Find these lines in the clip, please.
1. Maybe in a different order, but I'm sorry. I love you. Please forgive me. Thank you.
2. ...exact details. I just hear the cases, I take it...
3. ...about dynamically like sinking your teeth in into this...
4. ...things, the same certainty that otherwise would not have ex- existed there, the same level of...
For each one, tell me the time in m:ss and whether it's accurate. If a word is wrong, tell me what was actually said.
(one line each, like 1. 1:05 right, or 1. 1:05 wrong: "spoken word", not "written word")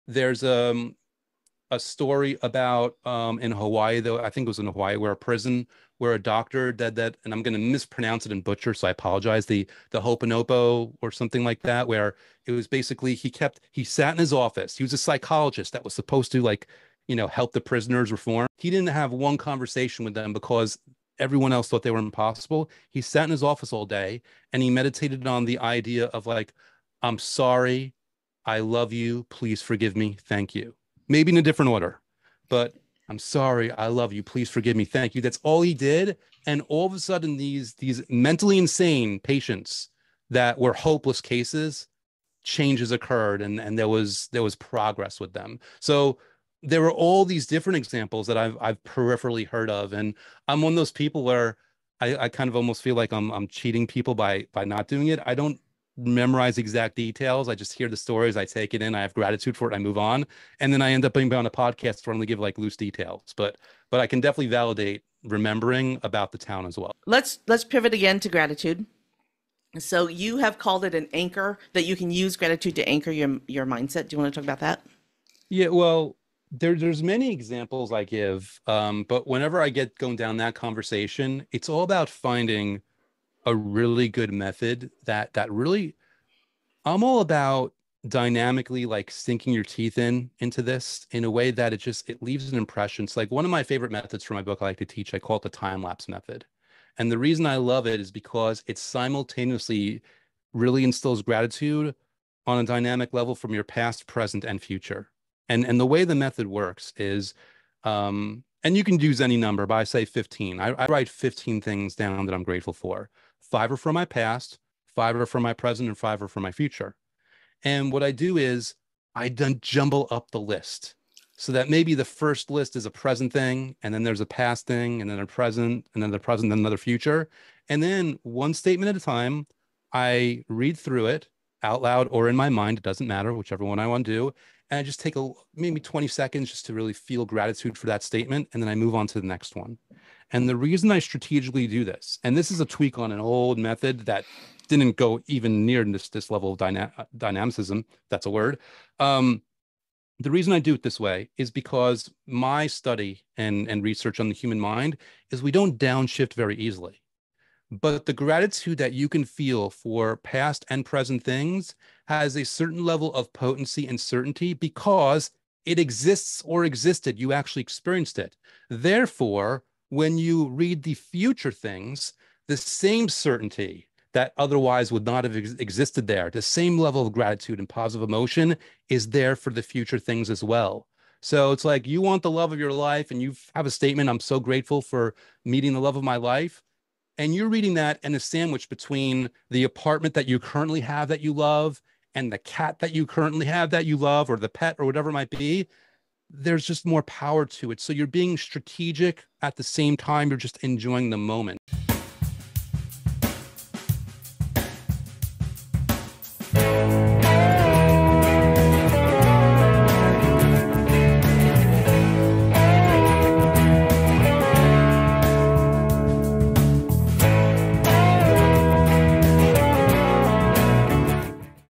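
1. 0:31 right
2. 0:56 wrong: "stories", not "cases"
3. 1:27 right
4. 2:51 right.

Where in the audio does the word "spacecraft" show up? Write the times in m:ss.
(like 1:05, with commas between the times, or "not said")
not said.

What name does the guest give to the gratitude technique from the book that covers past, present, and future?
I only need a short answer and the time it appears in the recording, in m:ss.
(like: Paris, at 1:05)
Time lapse method, at 1:35.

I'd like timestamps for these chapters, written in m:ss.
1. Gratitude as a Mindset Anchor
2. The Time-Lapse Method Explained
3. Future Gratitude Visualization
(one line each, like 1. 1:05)
1. 1:07
2. 1:34
3. 2:45.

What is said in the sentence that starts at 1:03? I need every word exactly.
But but I can definitely validate remembering about the town as well.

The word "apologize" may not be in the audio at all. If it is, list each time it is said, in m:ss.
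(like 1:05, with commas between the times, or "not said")
0:08.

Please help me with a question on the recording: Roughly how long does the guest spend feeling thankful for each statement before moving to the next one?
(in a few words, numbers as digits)
20 seconds.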